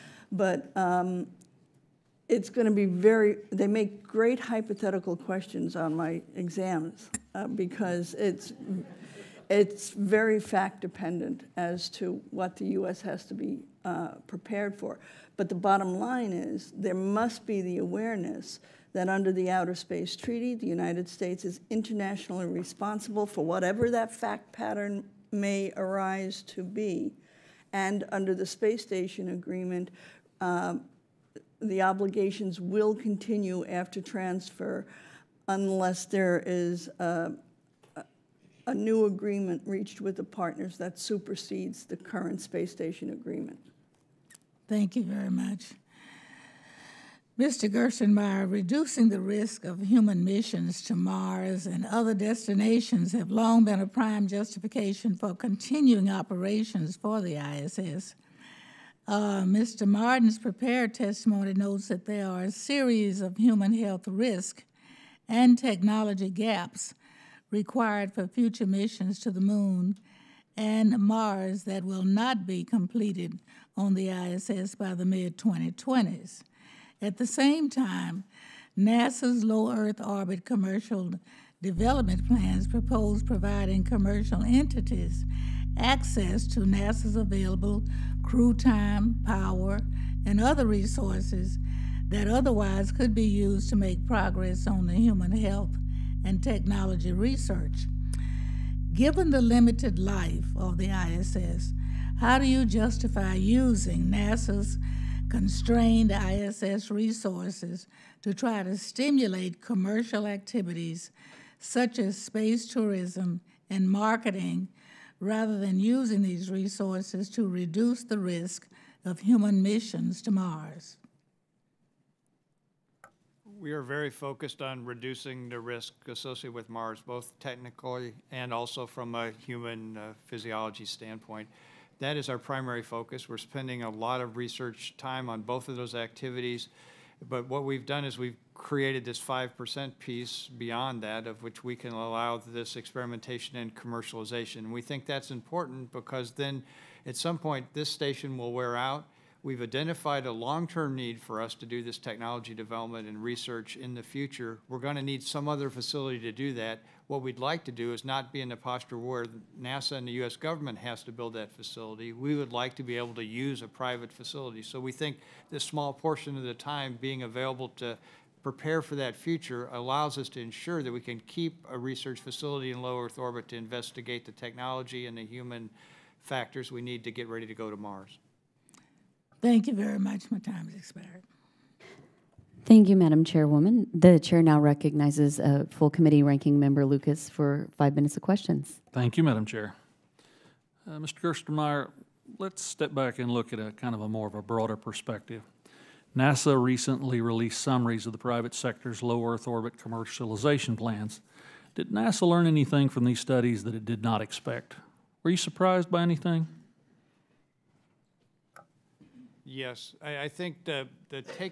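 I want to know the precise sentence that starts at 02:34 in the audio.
We're going to need some other facility to do that.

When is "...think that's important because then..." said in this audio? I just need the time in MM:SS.
02:24.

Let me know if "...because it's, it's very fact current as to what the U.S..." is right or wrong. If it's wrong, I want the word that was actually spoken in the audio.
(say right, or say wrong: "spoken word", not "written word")
wrong: "dependent", not "current".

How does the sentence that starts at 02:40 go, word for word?
government has to build that facility.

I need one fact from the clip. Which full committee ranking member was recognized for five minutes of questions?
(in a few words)
Lucas.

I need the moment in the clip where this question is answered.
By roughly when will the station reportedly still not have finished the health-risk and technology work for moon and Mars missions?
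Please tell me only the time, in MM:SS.
01:15.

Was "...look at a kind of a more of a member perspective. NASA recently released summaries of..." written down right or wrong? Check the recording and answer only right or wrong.
wrong.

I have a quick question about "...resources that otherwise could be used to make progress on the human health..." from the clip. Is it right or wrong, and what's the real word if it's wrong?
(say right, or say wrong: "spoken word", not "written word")
right.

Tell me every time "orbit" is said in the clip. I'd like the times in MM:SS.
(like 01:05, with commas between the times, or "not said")
01:20, 02:53, 03:19.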